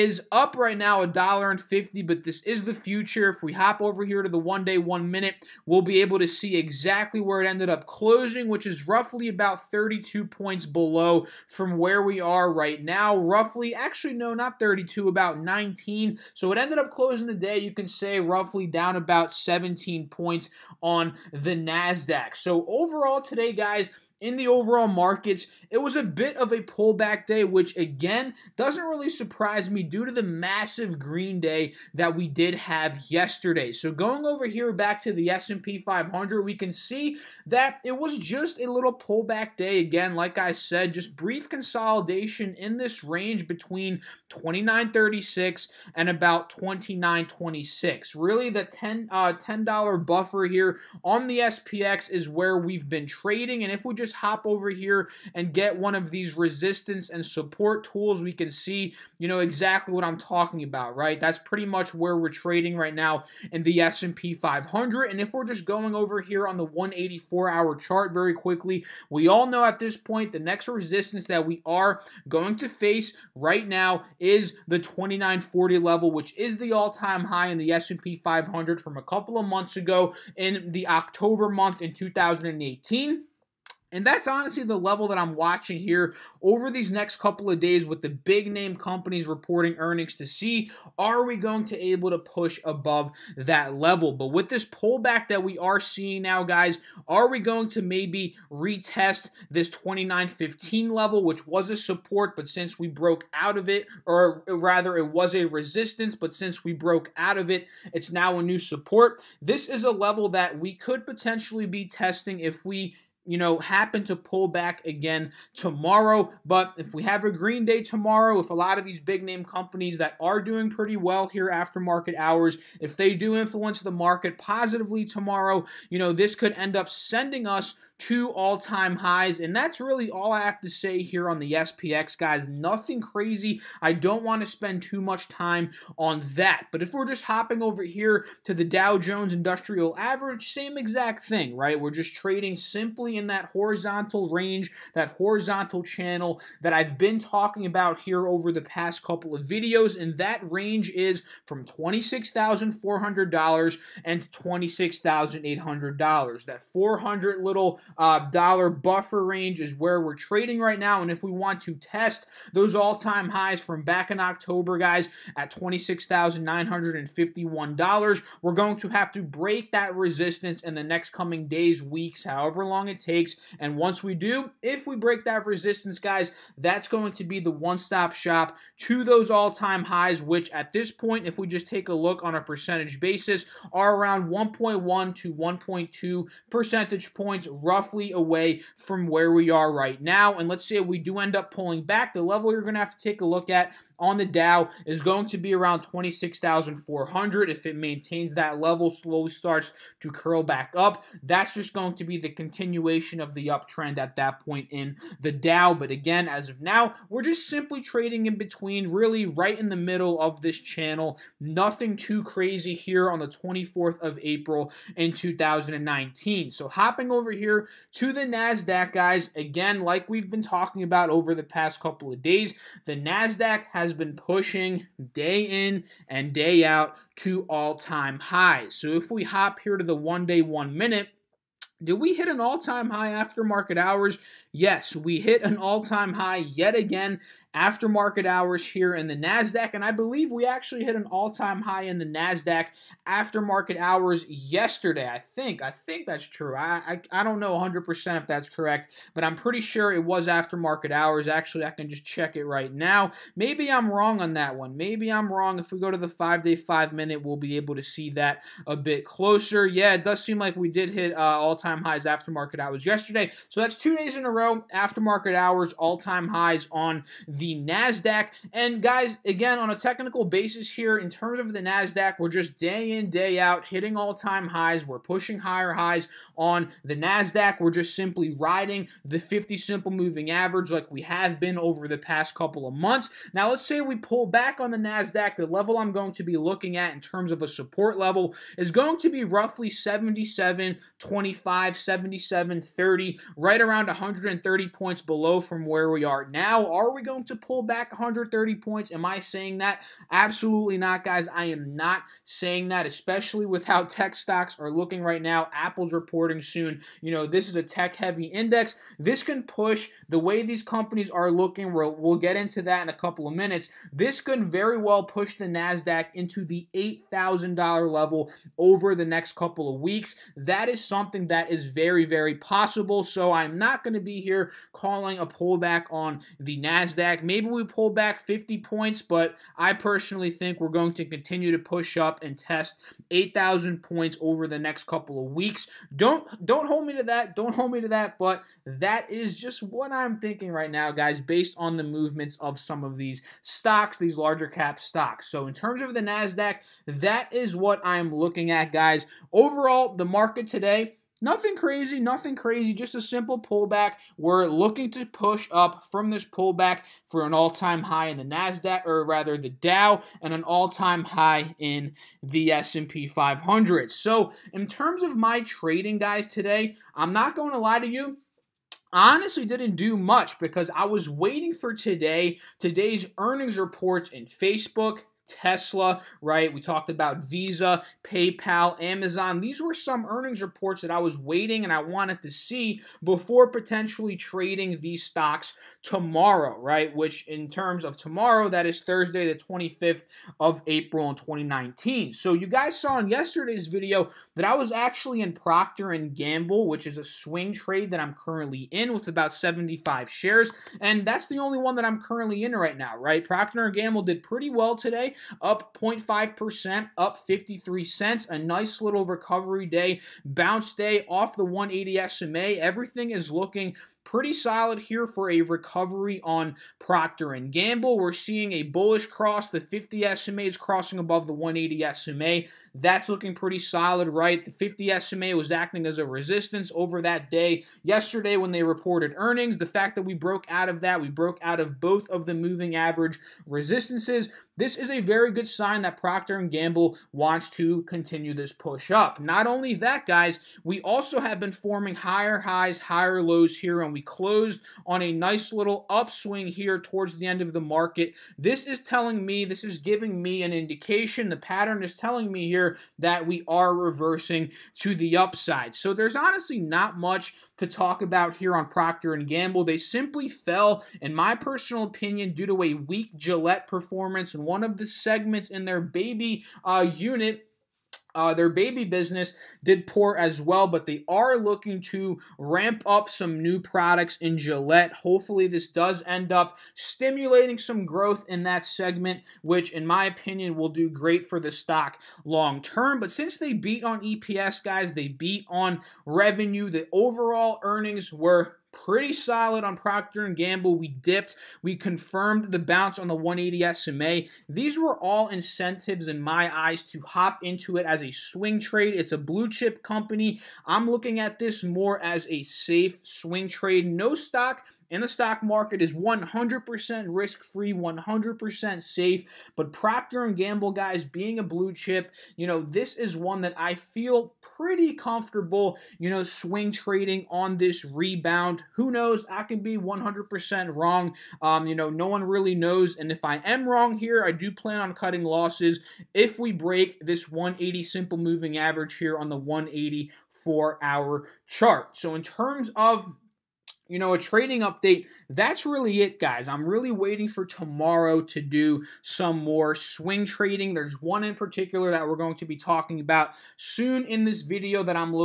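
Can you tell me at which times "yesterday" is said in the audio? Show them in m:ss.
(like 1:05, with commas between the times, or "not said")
0:33, 4:04, 4:22, 6:33, 7:07.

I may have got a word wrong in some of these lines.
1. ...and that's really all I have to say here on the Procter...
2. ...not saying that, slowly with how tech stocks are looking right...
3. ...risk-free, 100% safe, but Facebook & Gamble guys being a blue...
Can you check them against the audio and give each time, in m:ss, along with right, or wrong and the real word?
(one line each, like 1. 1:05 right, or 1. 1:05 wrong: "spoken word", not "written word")
1. 2:09 wrong: "SPX", not "Procter"
2. 5:01 wrong: "especially", not "slowly"
3. 8:27 wrong: "Procter", not "Facebook".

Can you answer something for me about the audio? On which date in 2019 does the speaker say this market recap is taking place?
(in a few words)
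24th of April.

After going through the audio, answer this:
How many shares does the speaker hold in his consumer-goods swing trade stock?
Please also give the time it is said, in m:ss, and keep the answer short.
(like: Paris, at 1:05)
75, at 6:39.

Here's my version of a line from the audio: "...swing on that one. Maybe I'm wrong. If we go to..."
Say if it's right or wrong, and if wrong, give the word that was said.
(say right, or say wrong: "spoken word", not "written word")
wrong: "wrong", not "swing".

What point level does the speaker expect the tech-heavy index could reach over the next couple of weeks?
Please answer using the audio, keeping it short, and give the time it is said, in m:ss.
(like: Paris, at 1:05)
8,000, at 5:16.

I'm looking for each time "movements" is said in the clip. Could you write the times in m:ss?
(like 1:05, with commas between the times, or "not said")
5:41.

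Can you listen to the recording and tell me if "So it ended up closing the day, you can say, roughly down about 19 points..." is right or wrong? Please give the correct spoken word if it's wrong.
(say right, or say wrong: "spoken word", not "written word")
wrong: "17", not "19".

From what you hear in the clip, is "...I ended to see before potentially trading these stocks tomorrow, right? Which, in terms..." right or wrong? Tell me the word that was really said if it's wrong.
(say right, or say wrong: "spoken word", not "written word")
wrong: "wanted", not "ended".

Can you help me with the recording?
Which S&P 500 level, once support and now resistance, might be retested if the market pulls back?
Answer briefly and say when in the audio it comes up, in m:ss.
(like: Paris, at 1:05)
29.15, at 1:39.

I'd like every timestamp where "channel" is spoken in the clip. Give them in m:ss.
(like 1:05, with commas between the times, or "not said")
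2:25, 3:30.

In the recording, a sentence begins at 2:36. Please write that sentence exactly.
That 400 little uh, dollar buffer range is where we're trading right now.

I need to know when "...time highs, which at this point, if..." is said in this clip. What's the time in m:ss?
2:59.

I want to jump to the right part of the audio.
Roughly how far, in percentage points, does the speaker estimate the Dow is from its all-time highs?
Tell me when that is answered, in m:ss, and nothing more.
3:04.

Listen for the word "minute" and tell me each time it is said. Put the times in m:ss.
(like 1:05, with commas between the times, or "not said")
0:05, 3:50, 4:16, 5:13.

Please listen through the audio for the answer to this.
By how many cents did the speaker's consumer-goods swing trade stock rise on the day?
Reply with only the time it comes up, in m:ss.
6:47.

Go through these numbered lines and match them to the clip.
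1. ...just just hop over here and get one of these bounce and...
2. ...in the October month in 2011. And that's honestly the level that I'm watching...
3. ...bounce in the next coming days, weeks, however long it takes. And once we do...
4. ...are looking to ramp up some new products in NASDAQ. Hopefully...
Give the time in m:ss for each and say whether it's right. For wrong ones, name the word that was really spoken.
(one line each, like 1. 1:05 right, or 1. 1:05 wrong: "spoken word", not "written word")
1. 0:53 wrong: "resistance", not "bounce"
2. 1:20 wrong: "2018", not "2011"
3. 2:49 wrong: "resistance", not "bounce"
4. 7:51 wrong: "Gillette", not "NASDAQ".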